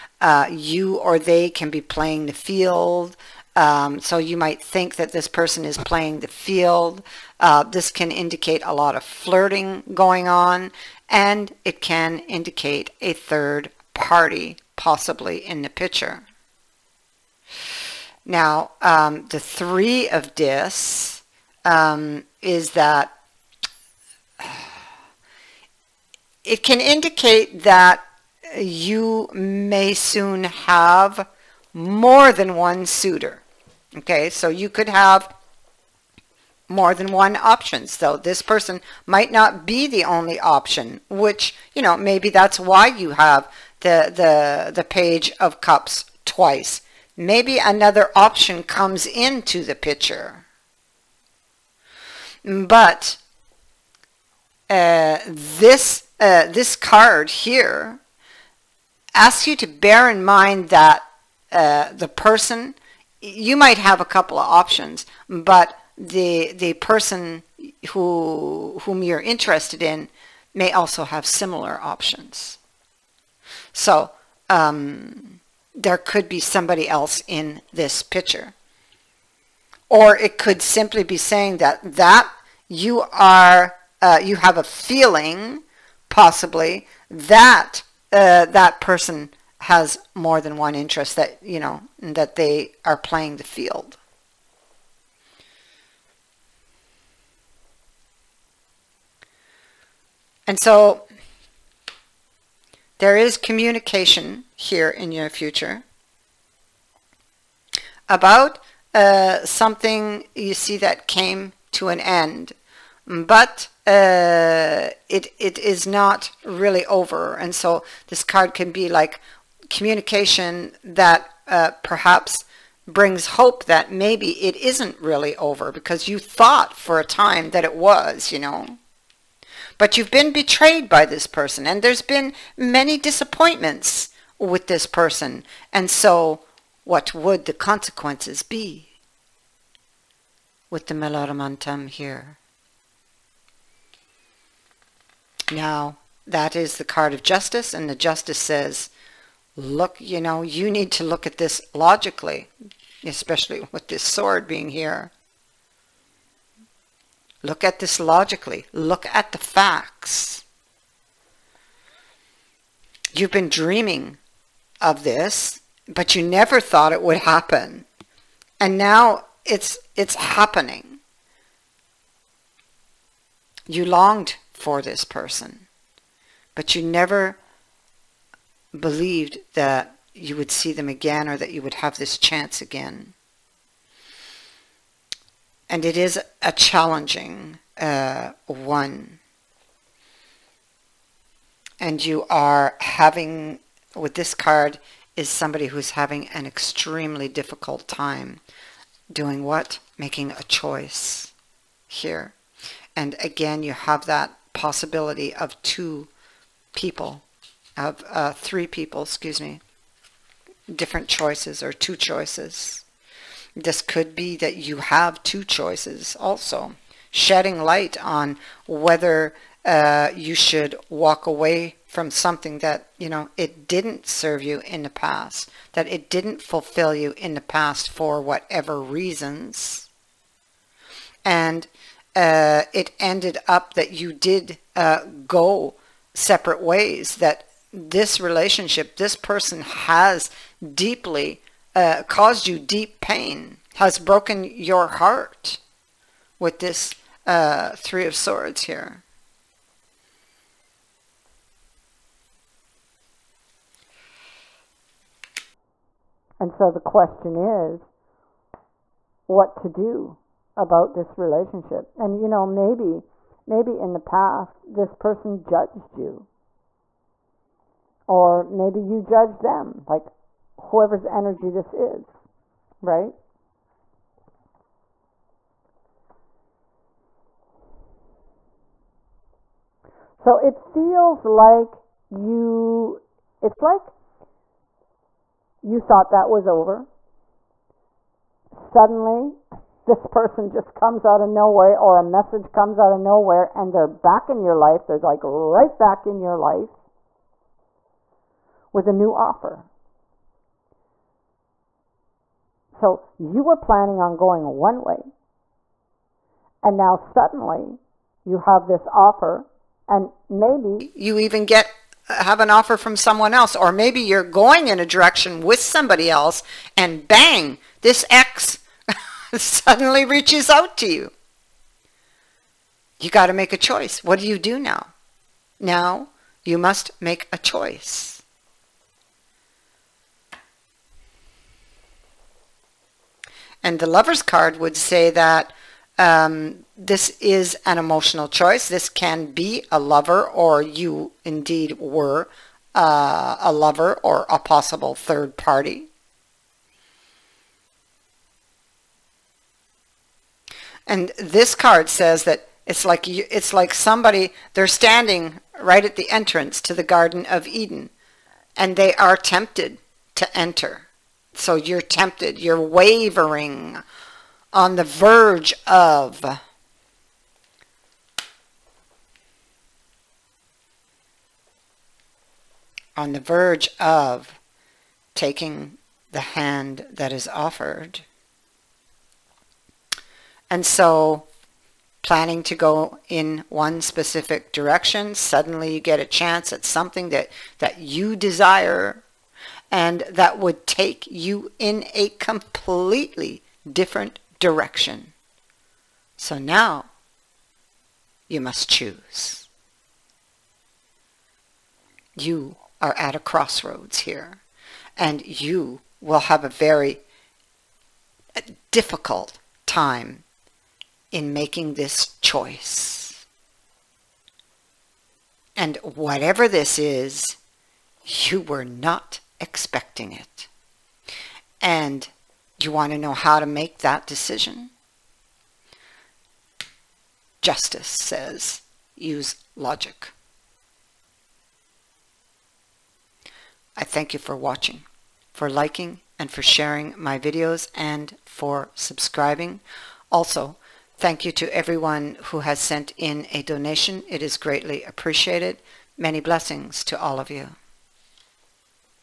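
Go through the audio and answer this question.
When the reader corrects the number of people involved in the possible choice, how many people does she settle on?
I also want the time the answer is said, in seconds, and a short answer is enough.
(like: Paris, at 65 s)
3, at 208 s.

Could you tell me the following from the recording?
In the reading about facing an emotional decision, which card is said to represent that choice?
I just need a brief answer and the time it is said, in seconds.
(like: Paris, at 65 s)
The Lovers, at 333 s.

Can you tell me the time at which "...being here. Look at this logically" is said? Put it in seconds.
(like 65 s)
154 s.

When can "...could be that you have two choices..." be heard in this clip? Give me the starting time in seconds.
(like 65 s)
213 s.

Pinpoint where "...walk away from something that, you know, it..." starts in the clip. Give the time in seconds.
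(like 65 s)
220 s.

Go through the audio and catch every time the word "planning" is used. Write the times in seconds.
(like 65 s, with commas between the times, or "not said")
303 s, 382 s.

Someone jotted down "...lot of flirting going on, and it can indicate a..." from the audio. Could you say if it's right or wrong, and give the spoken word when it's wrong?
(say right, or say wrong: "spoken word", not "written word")
right.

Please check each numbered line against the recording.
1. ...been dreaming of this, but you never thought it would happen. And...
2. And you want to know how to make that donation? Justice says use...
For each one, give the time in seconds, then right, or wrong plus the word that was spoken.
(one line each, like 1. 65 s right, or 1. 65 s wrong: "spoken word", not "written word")
1. 163 s right
2. 421 s wrong: "decision", not "donation".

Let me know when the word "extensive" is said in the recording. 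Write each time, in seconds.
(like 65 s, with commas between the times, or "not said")
not said.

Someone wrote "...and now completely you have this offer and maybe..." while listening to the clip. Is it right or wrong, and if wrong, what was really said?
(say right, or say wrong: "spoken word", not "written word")
wrong: "suddenly", not "completely".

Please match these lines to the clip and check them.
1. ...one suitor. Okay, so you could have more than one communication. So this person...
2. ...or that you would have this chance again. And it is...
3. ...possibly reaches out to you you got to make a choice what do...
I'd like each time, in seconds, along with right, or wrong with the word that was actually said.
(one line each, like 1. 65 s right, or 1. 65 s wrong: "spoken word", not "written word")
1. 32 s wrong: "option", not "communication"
2. 181 s right
3. 319 s wrong: "suddenly", not "possibly".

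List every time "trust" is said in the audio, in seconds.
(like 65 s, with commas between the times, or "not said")
not said.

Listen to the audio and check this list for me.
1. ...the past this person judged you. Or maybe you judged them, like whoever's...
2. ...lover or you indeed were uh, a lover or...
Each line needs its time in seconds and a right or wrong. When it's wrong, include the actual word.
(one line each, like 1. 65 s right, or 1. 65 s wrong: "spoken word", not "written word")
1. 263 s right
2. 339 s right.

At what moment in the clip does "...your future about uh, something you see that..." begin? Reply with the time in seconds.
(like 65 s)
105 s.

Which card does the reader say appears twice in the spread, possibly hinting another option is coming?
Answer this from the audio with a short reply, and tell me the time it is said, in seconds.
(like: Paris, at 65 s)
Page of Cups, at 44 s.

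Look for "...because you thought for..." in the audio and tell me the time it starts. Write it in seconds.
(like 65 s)
125 s.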